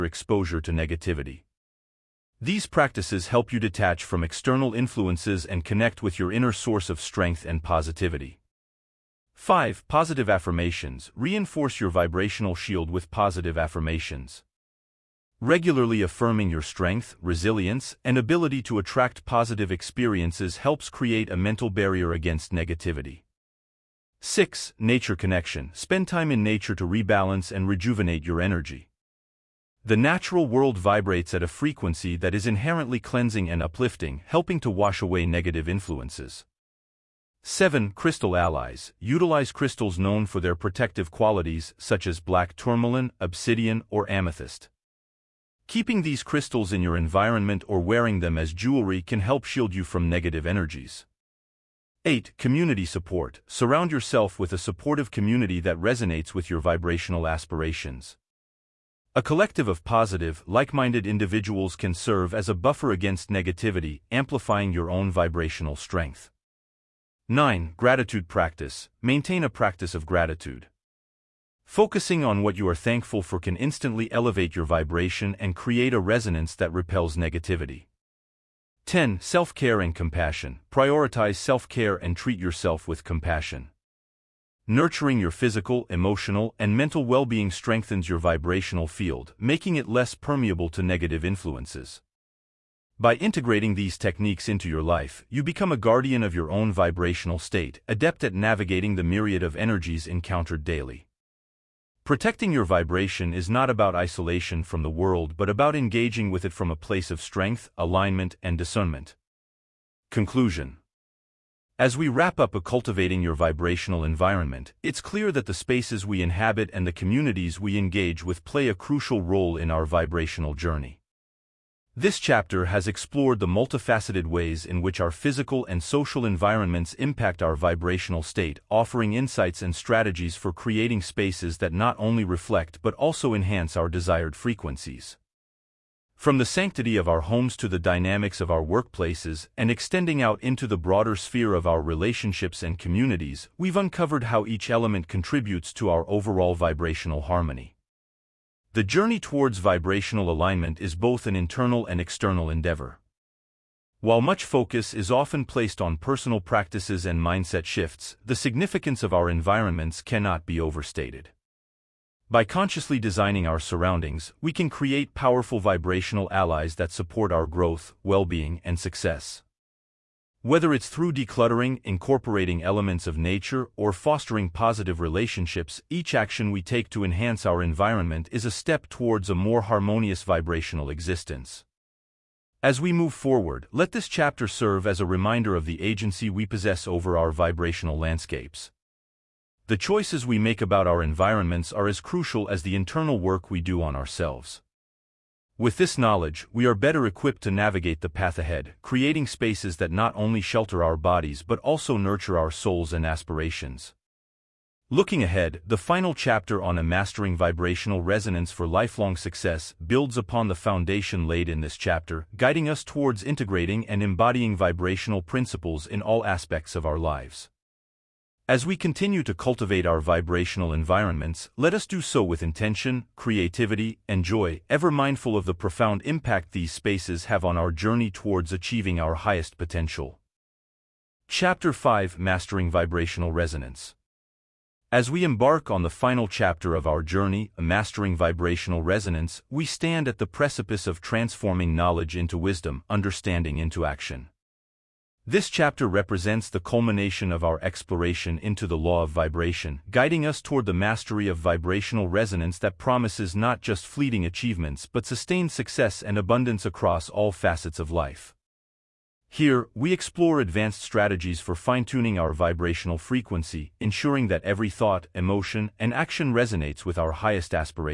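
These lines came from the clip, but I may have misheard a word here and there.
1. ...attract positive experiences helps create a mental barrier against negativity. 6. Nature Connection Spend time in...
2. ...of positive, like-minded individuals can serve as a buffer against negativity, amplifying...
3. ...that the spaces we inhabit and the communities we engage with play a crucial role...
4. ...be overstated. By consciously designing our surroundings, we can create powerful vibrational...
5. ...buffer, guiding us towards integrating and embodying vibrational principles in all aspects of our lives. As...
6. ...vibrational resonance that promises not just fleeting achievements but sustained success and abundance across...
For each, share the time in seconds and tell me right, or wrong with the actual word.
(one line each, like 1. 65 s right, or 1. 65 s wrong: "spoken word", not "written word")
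1. 18 s right
2. 59 s right
3. 115 s right
4. 160 s right
5. 211 s wrong: "chapter", not "buffer"
6. 251 s right.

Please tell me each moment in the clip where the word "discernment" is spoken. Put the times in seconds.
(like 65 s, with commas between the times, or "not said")
108 s.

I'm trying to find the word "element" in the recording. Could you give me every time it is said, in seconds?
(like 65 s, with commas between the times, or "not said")
144 s, 172 s.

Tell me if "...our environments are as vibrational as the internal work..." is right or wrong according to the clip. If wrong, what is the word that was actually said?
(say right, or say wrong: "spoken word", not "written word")
wrong: "crucial", not "vibrational".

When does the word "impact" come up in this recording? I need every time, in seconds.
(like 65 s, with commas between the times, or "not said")
126 s, 226 s.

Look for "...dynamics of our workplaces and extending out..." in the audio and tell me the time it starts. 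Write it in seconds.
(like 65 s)
137 s.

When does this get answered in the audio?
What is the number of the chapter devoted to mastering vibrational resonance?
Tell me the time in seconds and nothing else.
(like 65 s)
231 s.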